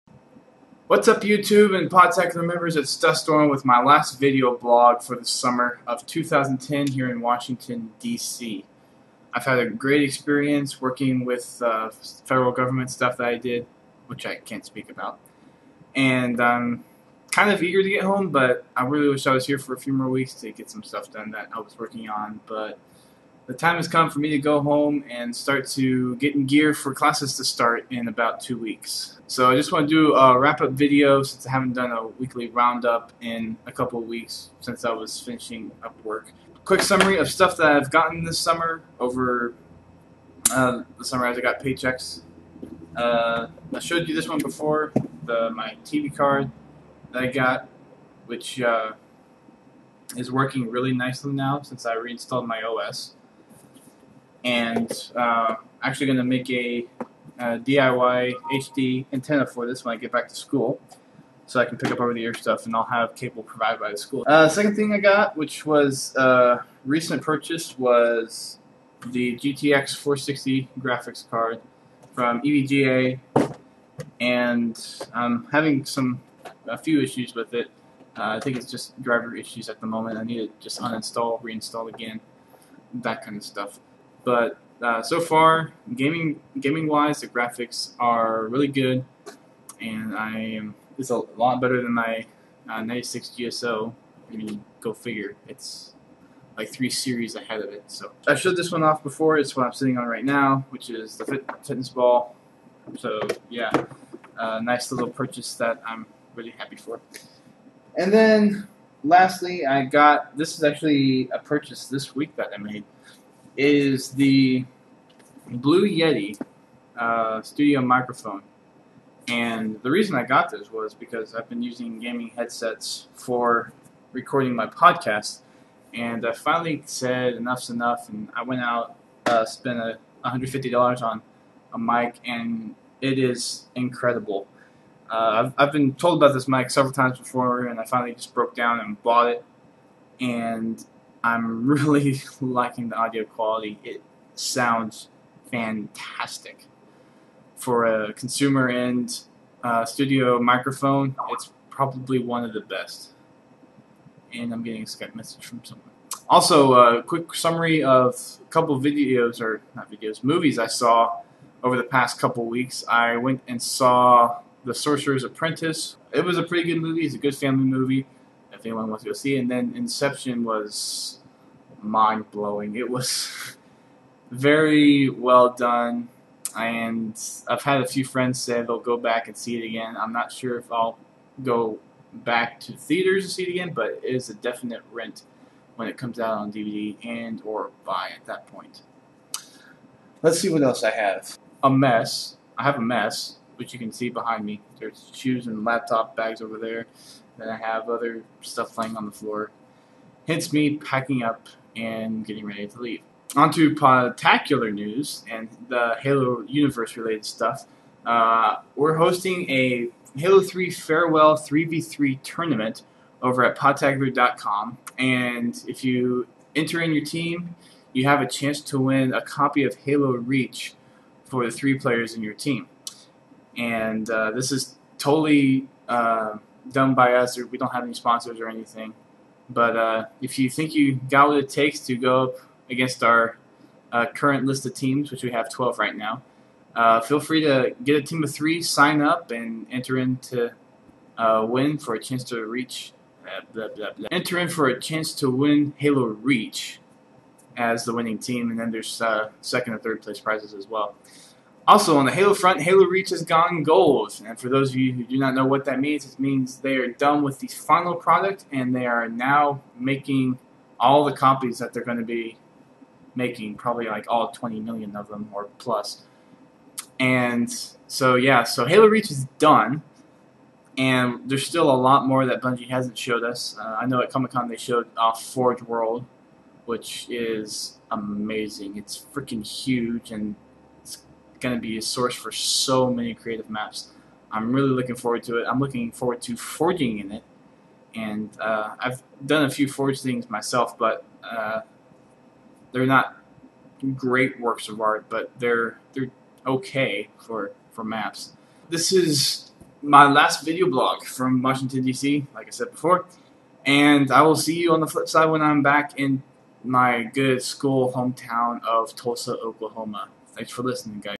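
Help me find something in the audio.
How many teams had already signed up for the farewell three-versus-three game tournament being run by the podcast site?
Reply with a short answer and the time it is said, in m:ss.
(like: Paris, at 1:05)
12, at 3:55.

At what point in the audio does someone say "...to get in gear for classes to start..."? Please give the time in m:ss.
0:25.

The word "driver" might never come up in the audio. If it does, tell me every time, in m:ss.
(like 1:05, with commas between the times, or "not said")
1:19.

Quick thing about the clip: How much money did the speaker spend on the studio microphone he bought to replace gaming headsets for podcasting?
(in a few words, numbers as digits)
$150.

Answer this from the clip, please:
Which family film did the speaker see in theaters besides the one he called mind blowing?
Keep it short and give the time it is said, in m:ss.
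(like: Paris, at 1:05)
The Sorcerer's Apprentice, at 2:44.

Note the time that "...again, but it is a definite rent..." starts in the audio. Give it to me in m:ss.
3:03.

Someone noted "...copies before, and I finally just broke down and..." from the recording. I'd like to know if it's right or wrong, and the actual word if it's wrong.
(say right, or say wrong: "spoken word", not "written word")
wrong: "times", not "copies".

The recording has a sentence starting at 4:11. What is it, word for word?
Also, on the Halo front, Halo Reach has gone gold.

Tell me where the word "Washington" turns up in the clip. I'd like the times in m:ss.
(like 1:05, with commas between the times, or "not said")
0:07, 5:01.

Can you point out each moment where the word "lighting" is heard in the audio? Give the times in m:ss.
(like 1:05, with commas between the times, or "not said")
not said.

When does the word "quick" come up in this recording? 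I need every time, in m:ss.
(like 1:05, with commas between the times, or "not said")
0:36, 2:37.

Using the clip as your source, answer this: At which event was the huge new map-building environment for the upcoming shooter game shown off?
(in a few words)
Comic Con.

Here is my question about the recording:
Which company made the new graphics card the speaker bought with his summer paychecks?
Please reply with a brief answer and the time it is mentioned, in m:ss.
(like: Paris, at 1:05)
EVGA, at 1:12.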